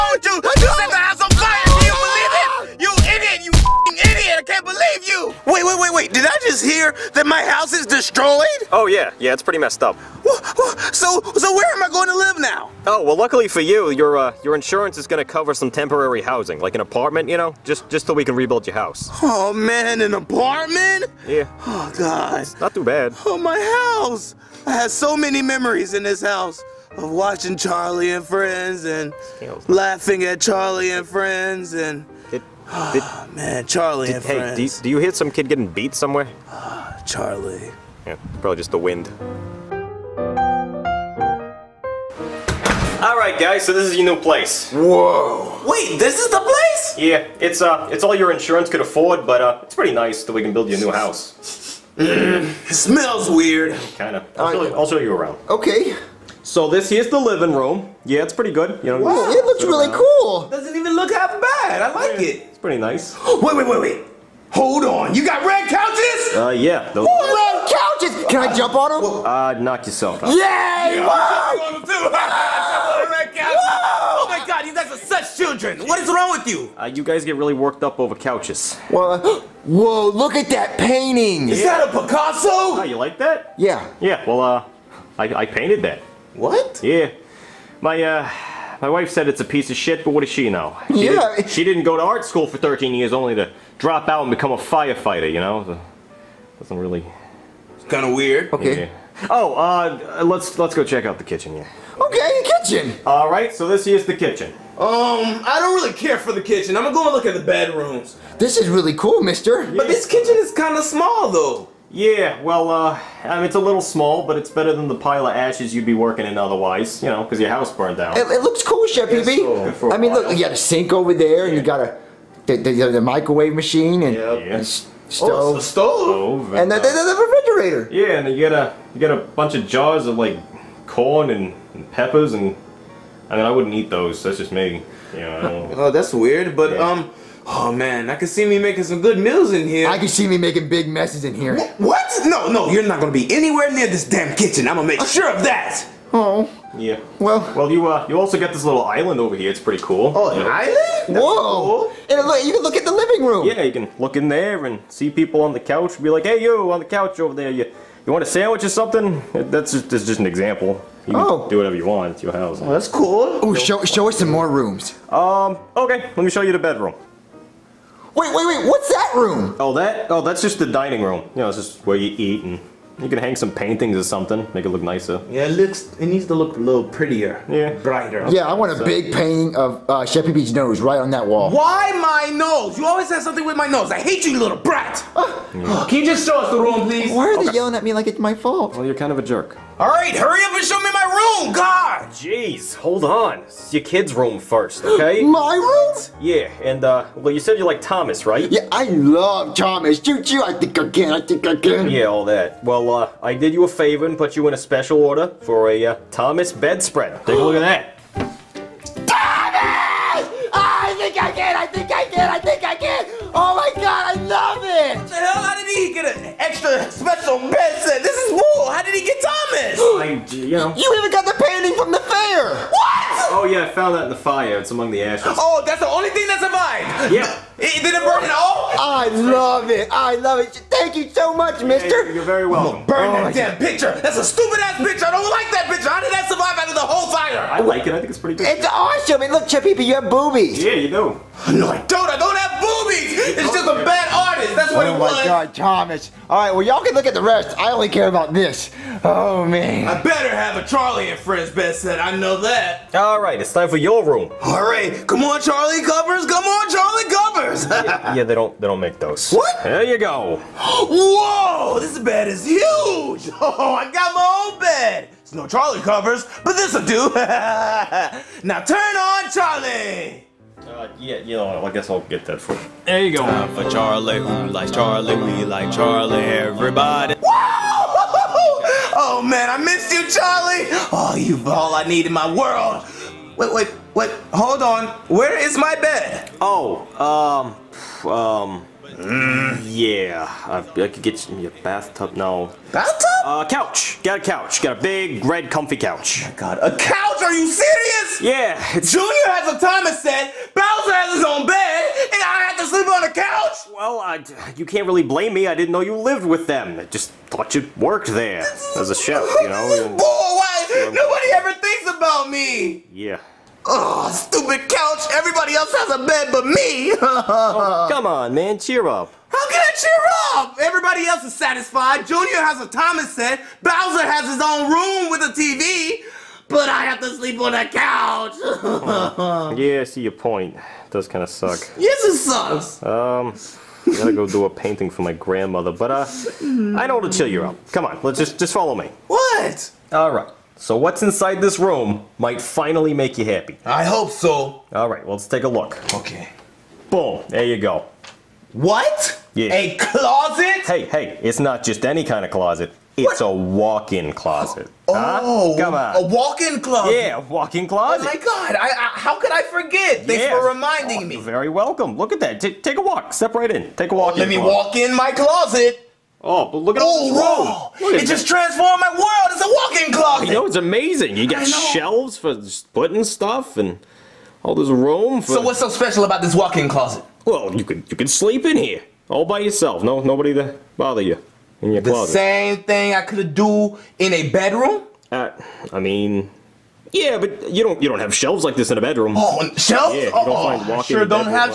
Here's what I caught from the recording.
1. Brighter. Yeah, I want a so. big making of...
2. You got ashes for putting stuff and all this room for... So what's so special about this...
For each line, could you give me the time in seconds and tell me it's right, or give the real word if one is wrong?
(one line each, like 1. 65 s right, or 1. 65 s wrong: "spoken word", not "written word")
1. 177 s wrong: "painting", not "making"
2. 371 s wrong: "shelves", not "ashes".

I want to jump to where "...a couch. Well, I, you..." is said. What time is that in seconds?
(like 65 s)
303 s.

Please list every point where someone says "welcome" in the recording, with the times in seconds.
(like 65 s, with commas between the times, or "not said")
232 s, 361 s.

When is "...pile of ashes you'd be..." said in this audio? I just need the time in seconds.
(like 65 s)
114 s.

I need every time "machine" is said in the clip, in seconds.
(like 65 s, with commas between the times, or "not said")
123 s.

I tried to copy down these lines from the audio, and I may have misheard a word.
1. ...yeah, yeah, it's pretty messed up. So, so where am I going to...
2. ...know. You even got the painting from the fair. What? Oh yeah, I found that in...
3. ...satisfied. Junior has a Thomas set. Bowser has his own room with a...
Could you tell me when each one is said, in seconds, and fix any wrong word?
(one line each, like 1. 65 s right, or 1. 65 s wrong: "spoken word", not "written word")
1. 8 s right
2. 220 s right
3. 321 s right.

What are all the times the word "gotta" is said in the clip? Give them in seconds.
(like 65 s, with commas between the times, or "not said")
333 s.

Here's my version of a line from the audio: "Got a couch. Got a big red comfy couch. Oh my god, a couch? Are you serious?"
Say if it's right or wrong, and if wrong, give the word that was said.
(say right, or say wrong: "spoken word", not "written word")
right.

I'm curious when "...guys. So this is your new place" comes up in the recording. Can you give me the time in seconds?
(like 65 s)
43 s.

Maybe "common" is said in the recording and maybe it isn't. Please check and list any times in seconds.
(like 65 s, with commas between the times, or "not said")
not said.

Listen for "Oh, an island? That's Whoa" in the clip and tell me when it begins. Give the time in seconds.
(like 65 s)
150 s.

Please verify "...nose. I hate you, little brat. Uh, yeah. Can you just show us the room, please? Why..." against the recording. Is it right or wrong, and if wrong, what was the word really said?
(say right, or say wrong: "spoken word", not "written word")
right.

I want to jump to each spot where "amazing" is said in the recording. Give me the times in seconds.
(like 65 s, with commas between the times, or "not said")
370 s.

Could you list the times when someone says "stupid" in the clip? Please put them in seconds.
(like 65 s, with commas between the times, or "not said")
234 s, 314 s.